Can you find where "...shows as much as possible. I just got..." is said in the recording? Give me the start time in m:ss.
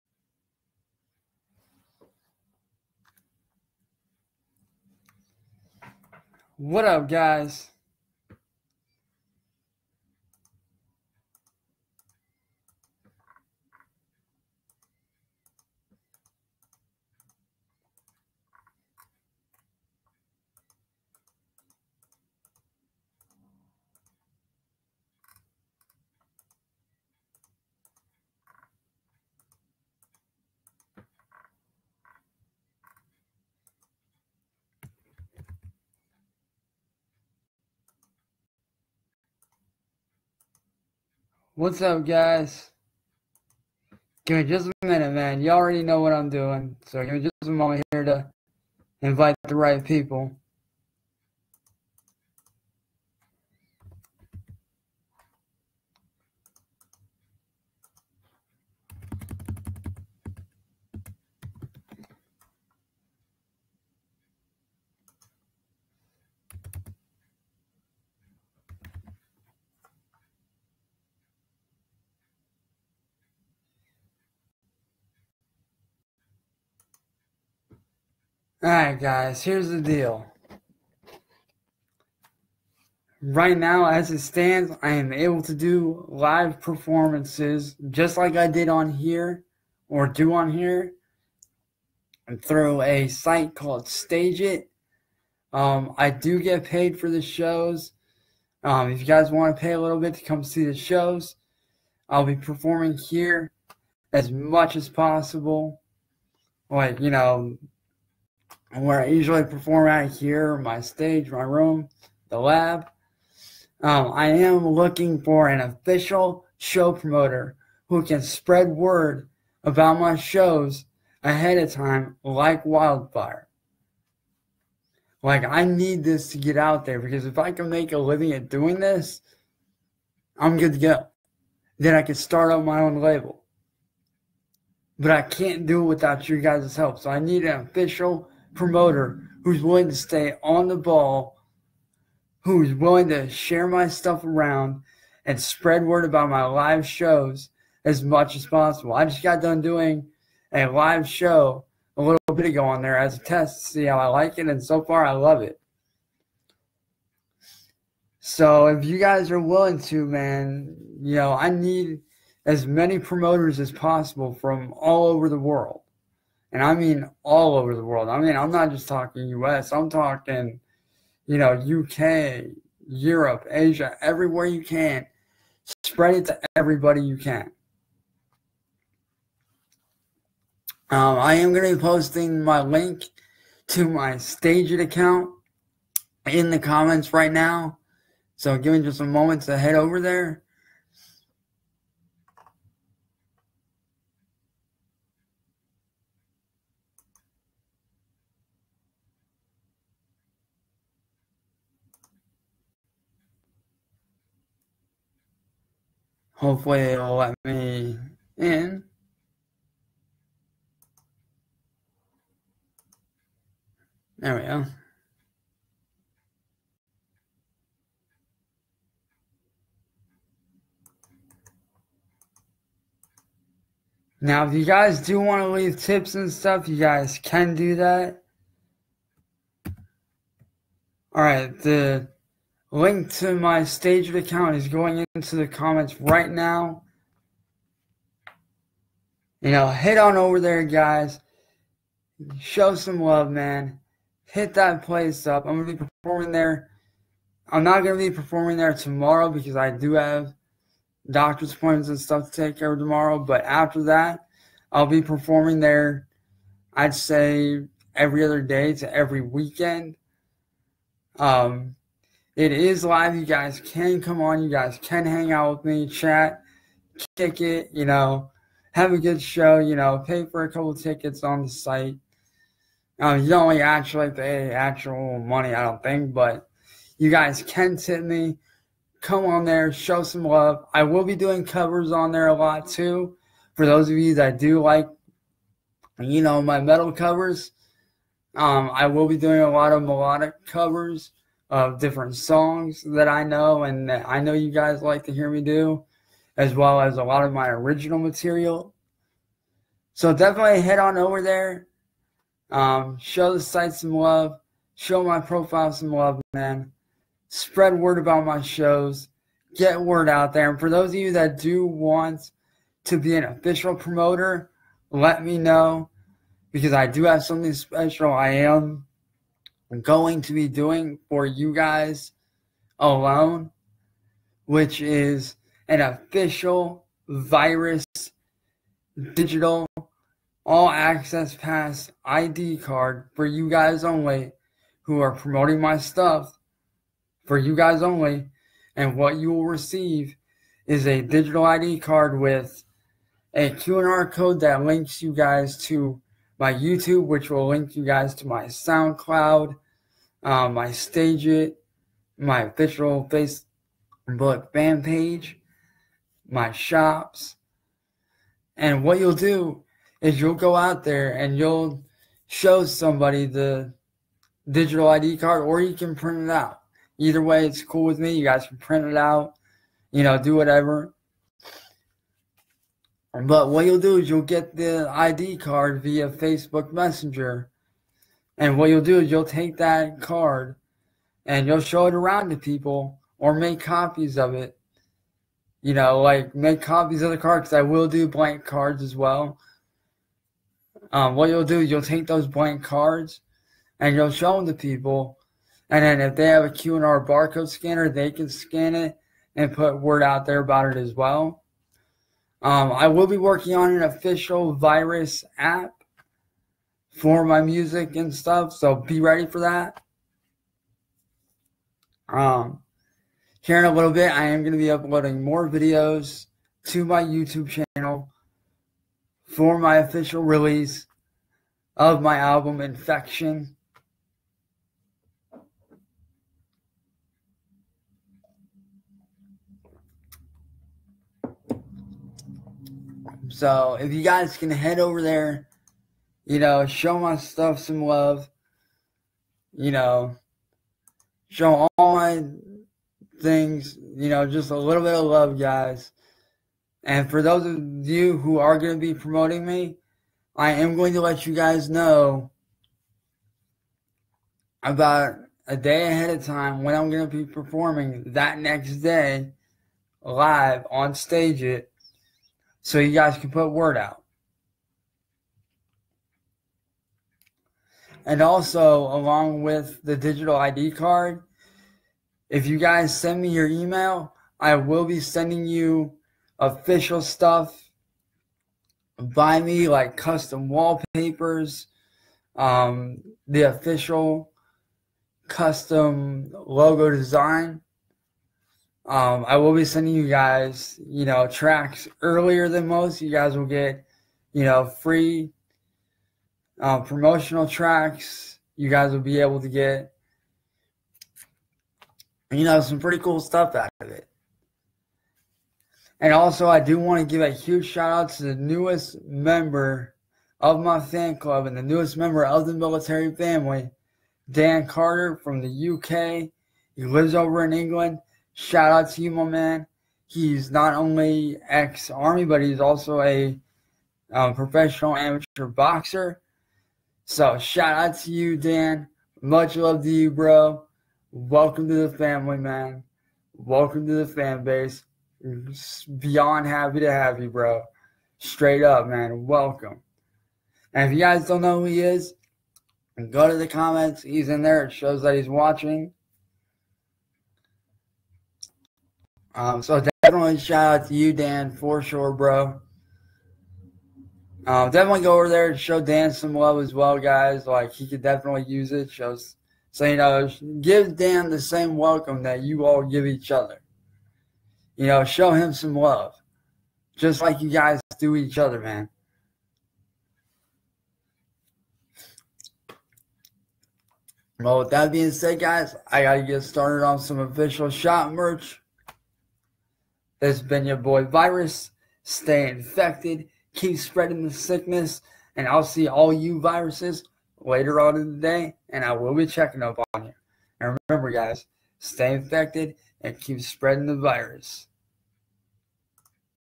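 2:26.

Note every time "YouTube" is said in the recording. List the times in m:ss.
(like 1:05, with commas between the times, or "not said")
5:46, 6:57.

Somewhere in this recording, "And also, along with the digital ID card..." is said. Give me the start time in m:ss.
7:48.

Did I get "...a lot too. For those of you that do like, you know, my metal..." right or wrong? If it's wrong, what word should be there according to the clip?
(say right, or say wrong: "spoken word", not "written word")
right.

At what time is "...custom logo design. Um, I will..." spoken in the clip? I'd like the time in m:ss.
8:05.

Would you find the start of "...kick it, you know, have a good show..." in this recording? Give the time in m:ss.
4:27.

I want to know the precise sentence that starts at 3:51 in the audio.
All right, the Link to my StageIt account is going into the comments right now.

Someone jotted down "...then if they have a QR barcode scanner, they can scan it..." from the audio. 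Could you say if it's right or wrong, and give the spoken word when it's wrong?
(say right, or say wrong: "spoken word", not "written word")
right.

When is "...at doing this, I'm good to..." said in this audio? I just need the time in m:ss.
2:08.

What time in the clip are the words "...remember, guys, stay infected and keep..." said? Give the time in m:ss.
9:50.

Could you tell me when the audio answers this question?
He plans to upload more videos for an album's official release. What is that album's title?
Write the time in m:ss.
7:02.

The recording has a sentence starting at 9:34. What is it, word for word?
Well, with that being said, guys, I gotta get started on some official shop merch.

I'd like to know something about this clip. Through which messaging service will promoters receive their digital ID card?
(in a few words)
Facebook Messenger.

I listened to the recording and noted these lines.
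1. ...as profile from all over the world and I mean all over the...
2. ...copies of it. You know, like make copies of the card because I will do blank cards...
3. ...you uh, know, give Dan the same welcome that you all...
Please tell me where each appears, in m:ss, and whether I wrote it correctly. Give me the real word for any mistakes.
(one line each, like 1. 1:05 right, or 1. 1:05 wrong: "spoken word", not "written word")
1. 2:43 wrong: "possible", not "profile"
2. 6:23 right
3. 9:19 right.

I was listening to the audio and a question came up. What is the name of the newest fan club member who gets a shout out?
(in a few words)
Dan Carter.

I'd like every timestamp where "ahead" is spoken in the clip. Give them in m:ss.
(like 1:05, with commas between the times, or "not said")
2:01, 7:35.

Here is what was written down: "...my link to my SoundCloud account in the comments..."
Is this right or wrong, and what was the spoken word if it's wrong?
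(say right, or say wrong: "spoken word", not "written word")
wrong: "Stageit", not "SoundCloud".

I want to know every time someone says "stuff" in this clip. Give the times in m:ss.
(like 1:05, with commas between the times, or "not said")
2:23, 3:46, 4:11, 5:35, 6:48, 7:17, 7:57, 8:23.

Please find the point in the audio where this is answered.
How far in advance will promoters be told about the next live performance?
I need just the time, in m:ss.
7:34.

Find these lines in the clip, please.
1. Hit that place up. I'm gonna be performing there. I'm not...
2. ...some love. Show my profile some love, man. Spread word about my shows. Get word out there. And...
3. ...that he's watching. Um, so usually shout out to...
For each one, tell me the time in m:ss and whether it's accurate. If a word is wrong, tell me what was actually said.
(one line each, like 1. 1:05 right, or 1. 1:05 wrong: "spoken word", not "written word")
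1. 4:04 right
2. 5:03 right
3. 9:05 wrong: "definitely", not "usually".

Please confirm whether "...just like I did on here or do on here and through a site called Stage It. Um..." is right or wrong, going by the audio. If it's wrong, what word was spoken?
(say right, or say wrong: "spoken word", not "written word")
right.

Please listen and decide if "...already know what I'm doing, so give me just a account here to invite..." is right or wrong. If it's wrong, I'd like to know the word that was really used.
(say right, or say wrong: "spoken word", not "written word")
wrong: "moment", not "account".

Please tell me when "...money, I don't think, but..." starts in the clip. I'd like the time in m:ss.
4:35.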